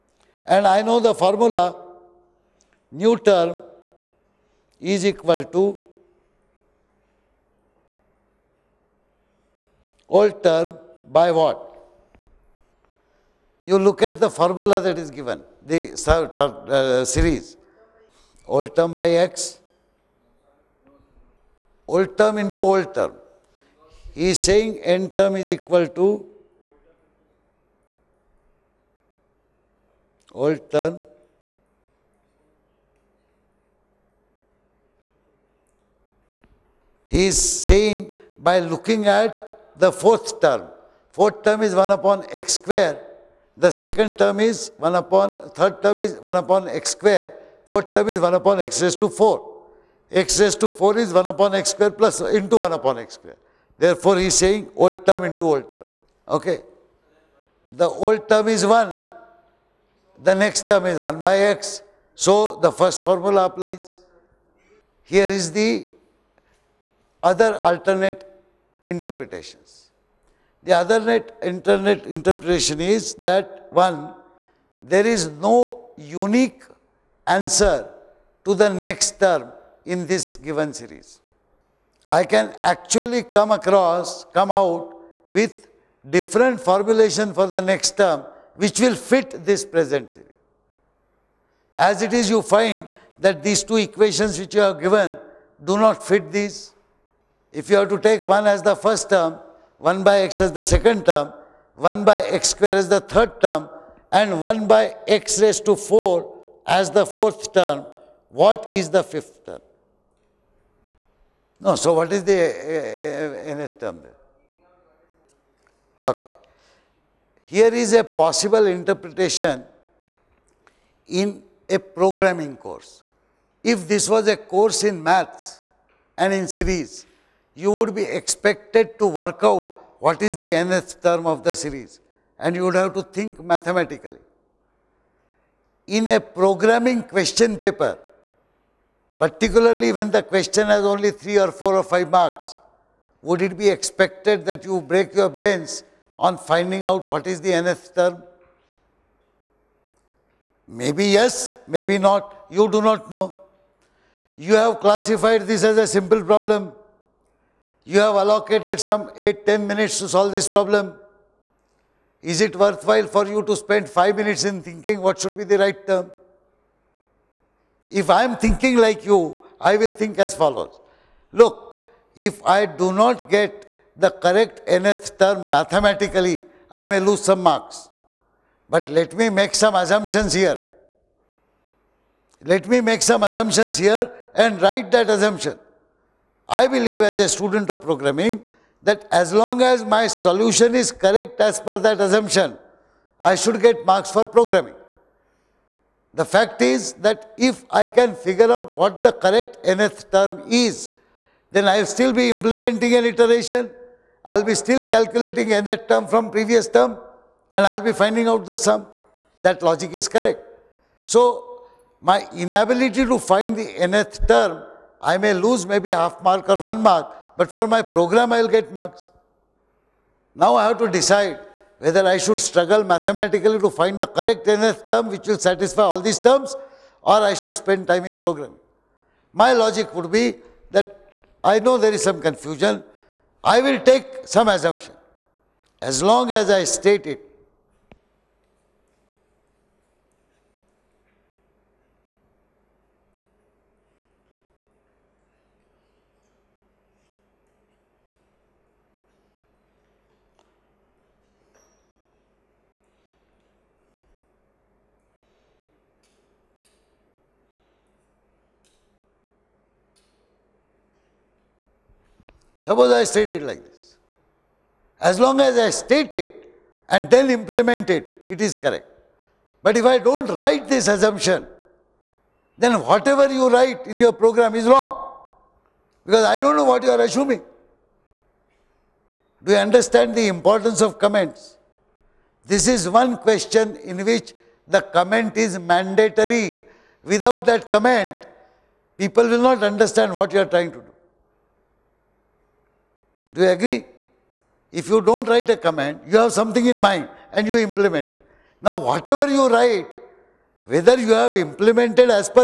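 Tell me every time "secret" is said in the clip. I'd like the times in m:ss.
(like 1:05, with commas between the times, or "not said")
not said.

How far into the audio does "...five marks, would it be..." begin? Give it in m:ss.
2:21.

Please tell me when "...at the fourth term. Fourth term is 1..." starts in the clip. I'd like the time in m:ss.
0:39.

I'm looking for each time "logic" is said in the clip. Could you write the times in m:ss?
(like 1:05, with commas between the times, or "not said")
3:29, 3:49.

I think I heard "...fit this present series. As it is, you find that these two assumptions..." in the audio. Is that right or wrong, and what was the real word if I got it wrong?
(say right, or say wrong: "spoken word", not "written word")
wrong: "equations", not "assumptions".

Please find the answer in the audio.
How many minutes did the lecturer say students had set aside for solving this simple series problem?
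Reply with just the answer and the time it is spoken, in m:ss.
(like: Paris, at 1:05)
8-10 minutes, at 2:39.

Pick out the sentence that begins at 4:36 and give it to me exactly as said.
Because I don't know what you are assuming.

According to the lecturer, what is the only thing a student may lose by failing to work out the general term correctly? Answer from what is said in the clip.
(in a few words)
half mark or one mark.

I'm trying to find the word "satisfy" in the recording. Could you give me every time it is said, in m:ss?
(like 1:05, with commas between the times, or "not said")
3:45.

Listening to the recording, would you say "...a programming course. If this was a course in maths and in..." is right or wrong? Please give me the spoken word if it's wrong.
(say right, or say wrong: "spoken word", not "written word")
right.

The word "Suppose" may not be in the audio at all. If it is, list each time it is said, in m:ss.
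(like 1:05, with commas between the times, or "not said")
4:22.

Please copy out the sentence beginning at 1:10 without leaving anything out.
The alternate internet interpretation is that one, there is no unique answer to the next term in this given series.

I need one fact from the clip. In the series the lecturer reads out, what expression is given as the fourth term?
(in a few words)
1/x^4.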